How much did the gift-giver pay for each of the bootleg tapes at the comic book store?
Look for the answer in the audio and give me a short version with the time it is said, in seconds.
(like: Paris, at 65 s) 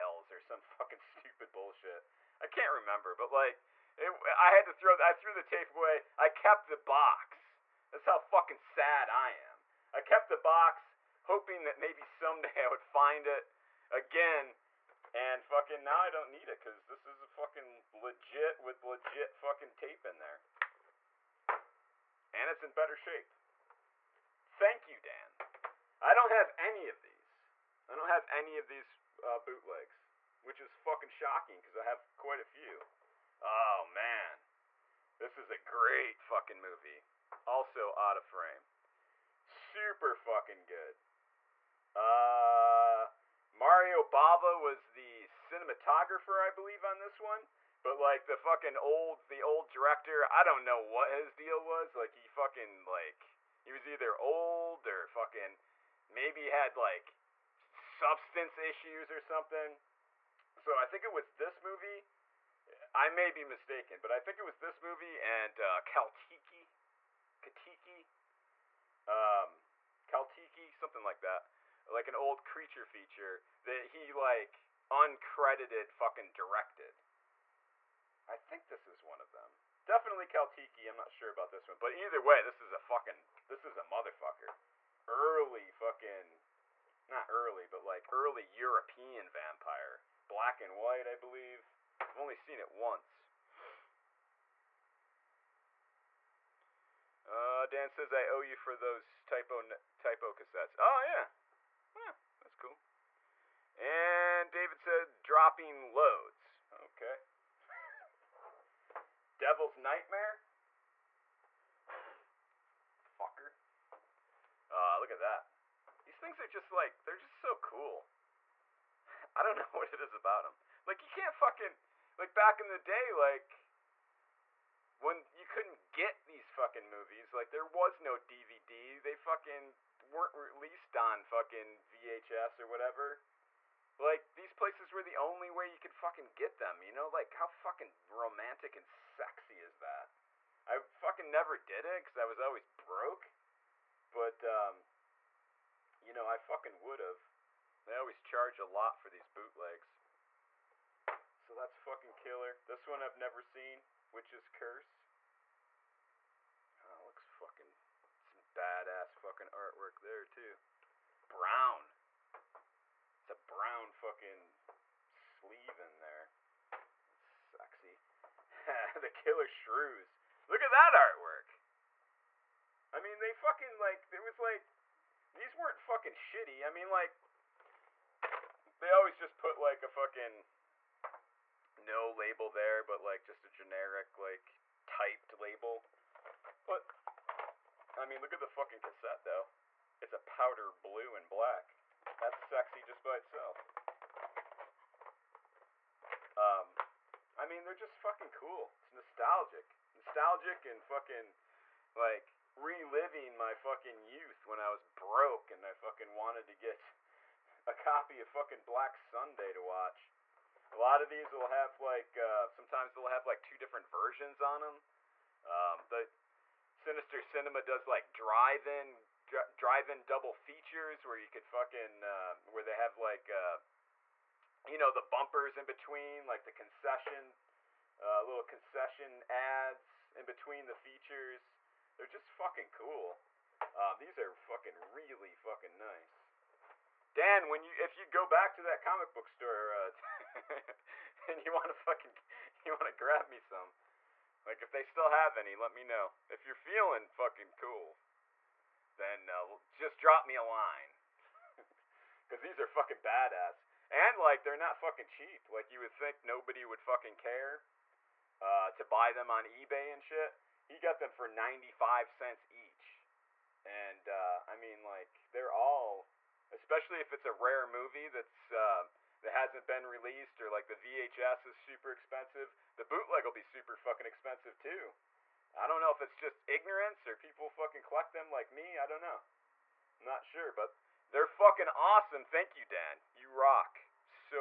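95 cents, at 261 s.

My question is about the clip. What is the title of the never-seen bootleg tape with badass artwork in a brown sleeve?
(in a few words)
Witch's Curse.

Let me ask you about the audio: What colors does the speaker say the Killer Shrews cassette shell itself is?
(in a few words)
Powder blue and black.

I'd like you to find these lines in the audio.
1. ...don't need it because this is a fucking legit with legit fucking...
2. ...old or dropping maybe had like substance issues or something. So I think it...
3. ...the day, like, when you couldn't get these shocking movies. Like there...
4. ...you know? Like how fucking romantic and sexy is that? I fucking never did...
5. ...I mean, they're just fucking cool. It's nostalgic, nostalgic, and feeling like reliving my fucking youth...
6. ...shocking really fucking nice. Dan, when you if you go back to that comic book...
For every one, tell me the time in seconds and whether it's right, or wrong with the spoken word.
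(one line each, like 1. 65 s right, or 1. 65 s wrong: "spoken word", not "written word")
1. 16 s right
2. 54 s wrong: "fucking", not "dropping"
3. 122 s wrong: "fucking", not "shocking"
4. 136 s right
5. 197 s wrong: "fucking", not "feeling"
6. 234 s wrong: "fucking", not "shocking".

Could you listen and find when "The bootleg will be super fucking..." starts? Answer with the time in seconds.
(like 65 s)
272 s.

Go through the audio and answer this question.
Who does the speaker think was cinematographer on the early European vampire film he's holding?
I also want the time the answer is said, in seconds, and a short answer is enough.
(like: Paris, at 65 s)
Mario Bava, at 43 s.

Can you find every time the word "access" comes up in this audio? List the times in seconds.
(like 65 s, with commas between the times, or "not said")
not said.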